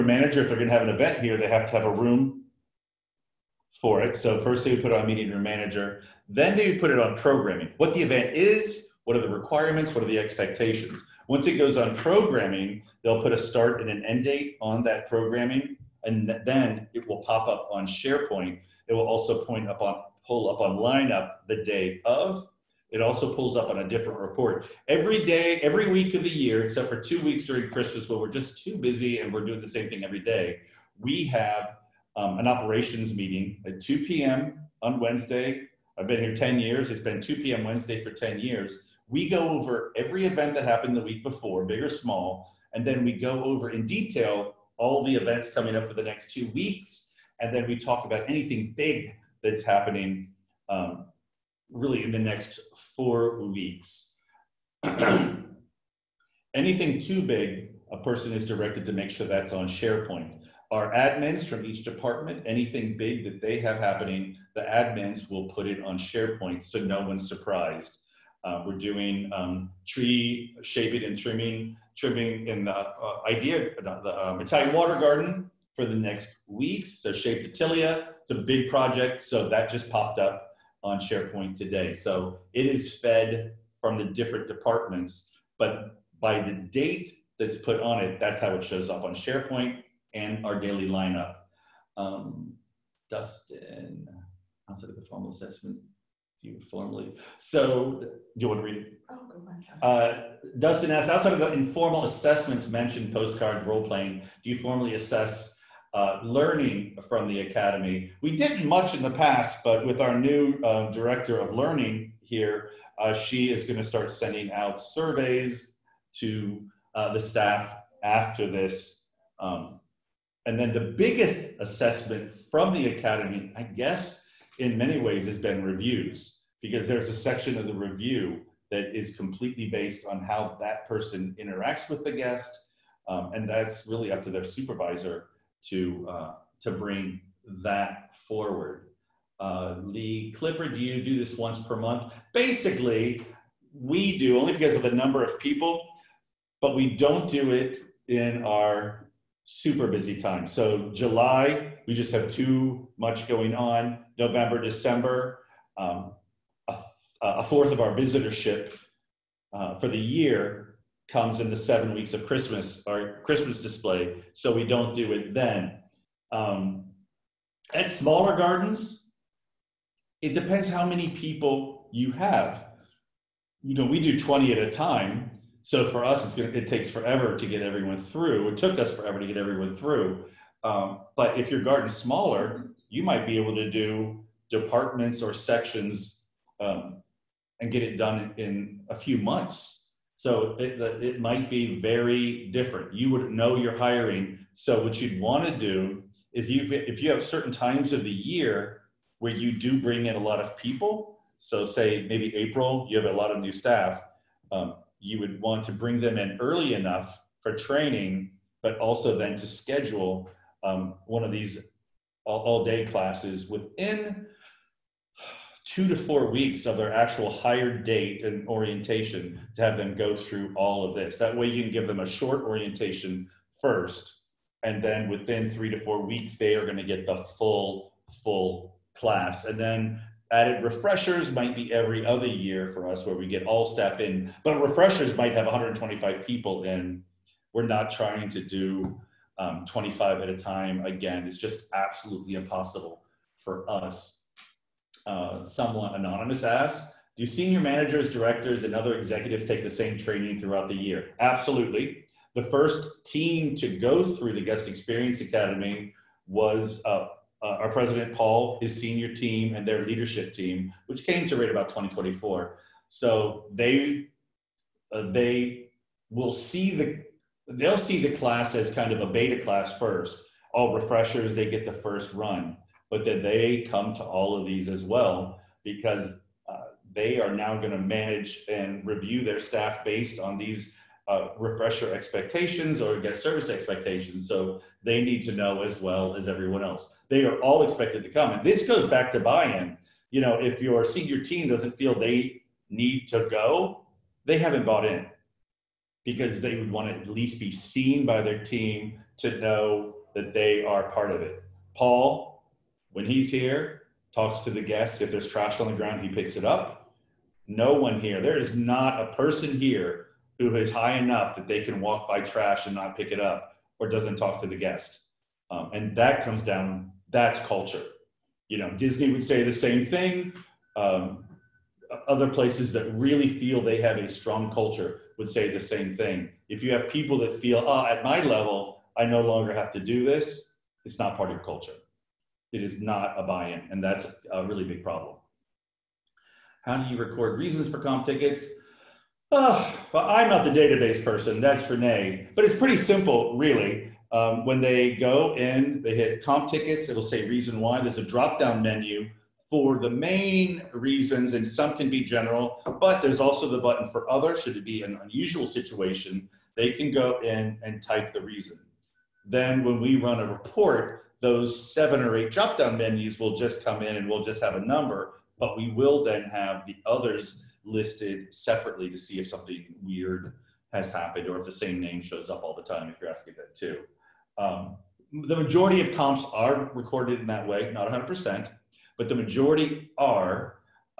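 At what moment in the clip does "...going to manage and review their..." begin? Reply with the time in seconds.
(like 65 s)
277 s.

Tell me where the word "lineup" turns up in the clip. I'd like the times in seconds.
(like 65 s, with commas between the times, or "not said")
20 s, 90 s.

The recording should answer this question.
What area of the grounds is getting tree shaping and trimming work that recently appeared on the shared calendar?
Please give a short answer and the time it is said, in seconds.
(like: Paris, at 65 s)
Italian water garden, at 74 s.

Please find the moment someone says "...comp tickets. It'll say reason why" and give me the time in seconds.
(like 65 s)
346 s.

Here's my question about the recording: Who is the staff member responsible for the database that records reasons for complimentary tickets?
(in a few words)
Renee.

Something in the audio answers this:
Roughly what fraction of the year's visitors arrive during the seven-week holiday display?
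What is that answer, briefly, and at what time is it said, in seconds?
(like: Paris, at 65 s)
a fourth, at 157 s.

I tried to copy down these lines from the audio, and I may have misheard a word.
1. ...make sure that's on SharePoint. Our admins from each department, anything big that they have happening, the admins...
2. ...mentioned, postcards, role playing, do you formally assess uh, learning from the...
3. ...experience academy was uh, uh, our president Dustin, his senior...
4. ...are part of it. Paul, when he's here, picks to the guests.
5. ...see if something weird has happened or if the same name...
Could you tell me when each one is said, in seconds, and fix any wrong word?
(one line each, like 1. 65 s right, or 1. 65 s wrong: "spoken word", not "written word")
1. 58 s right
2. 102 s right
3. 254 s wrong: "Paul", not "Dustin"
4. 300 s wrong: "talks", not "picks"
5. 368 s right.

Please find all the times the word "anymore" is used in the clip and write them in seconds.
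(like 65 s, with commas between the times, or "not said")
not said.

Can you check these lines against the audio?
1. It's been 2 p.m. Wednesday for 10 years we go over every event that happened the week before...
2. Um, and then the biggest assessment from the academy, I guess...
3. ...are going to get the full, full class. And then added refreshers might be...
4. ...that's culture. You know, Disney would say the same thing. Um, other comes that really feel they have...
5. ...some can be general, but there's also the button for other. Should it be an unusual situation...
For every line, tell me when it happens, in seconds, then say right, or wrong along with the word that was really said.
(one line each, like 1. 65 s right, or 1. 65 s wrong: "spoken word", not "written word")
1. 36 s right
2. 119 s right
3. 226 s right
4. 317 s wrong: "places", not "comes"
5. 351 s right.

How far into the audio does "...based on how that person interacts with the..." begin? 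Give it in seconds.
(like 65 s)
129 s.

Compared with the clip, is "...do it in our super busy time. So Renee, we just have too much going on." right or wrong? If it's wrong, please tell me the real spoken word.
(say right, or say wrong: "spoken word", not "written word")
wrong: "July", not "Renee".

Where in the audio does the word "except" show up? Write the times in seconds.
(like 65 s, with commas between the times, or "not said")
26 s.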